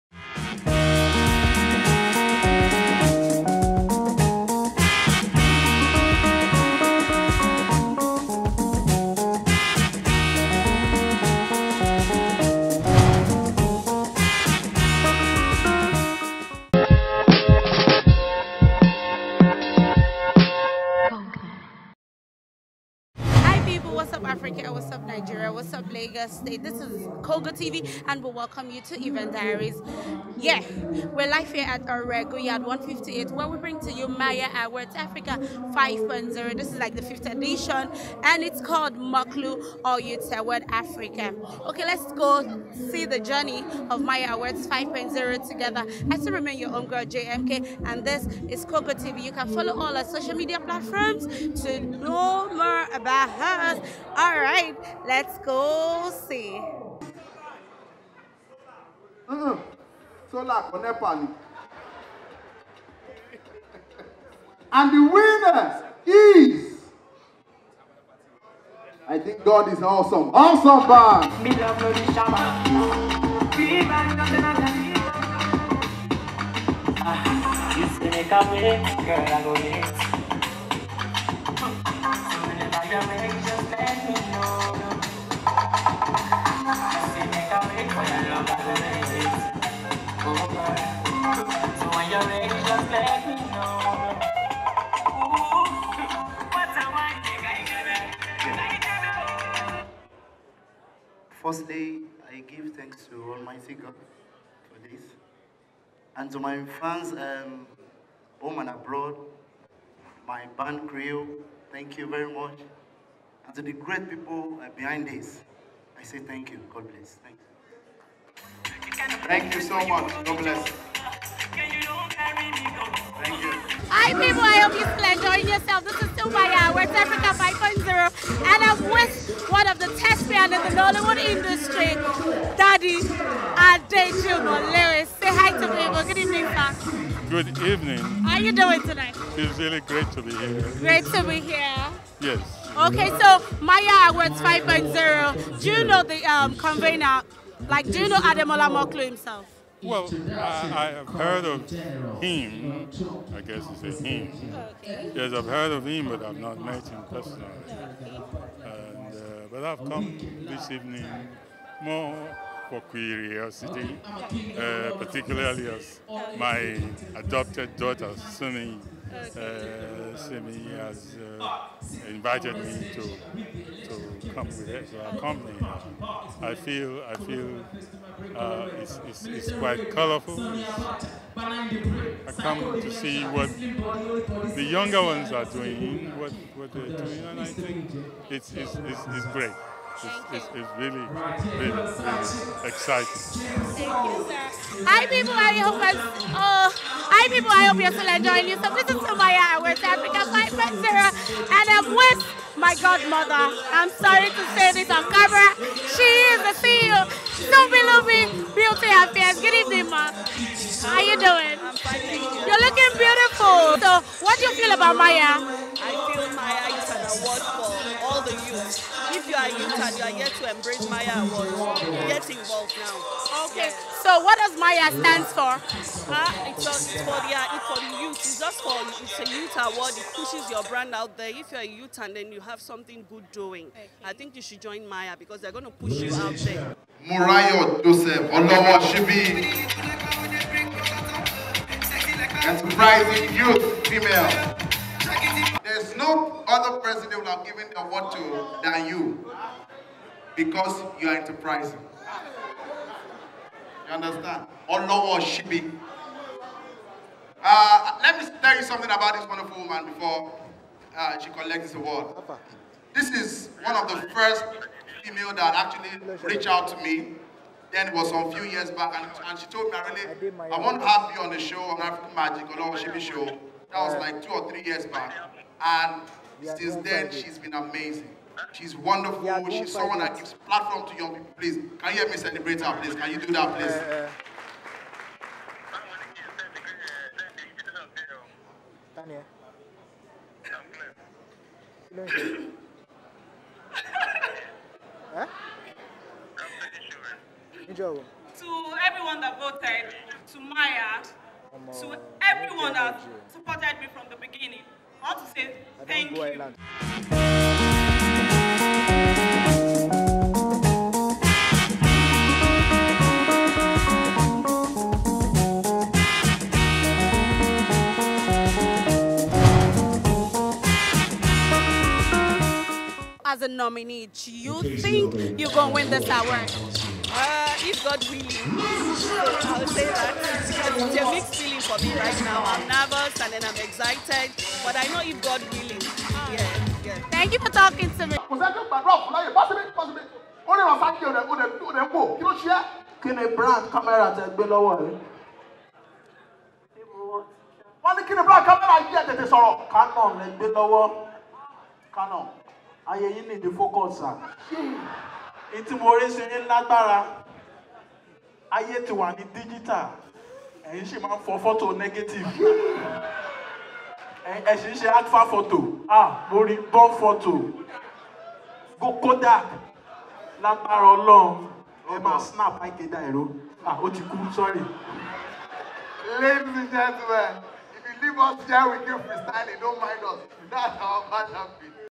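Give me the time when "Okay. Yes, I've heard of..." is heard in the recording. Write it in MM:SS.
02:34.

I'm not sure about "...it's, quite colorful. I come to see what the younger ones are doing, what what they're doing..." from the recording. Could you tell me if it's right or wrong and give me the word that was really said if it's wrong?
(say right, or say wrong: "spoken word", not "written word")
right.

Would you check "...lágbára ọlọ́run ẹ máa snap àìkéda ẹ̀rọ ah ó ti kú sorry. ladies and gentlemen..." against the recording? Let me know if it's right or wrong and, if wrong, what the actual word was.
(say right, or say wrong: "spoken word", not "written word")
right.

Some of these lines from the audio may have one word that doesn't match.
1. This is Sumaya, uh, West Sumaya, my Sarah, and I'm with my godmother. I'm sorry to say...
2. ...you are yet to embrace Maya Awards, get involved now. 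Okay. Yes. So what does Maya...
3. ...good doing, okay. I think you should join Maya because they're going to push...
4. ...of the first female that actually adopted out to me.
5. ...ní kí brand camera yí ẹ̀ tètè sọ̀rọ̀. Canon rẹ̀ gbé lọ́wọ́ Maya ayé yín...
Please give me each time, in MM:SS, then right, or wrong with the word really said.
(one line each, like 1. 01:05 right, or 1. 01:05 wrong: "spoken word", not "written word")
1. 03:18 wrong: "Africa", not "Sumaya"
2. 03:39 right
3. 03:53 right
4. 04:23 wrong: "reached", not "adopted"
5. 05:47 wrong: "Canon", not "Maya".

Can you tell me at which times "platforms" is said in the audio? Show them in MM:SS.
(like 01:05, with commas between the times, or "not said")
00:50, 04:40.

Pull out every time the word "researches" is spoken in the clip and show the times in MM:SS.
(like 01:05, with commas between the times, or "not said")
not said.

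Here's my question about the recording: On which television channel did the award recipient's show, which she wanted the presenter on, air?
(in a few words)
African Magic.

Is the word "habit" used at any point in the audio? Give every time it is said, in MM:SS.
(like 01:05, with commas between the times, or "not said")
06:21.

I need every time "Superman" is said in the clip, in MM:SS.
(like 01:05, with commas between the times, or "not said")
not said.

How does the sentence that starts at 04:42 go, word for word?
Can you do that, eh, please?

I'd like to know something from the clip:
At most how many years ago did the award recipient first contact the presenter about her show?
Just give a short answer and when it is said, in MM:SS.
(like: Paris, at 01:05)
3, at 04:34.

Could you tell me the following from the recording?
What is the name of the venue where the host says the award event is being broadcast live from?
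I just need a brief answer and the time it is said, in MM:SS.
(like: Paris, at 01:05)
Orego Yard 158, at 00:31.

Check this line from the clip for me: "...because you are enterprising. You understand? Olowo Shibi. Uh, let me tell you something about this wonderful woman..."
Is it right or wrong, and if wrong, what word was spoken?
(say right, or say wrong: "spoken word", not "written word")
right.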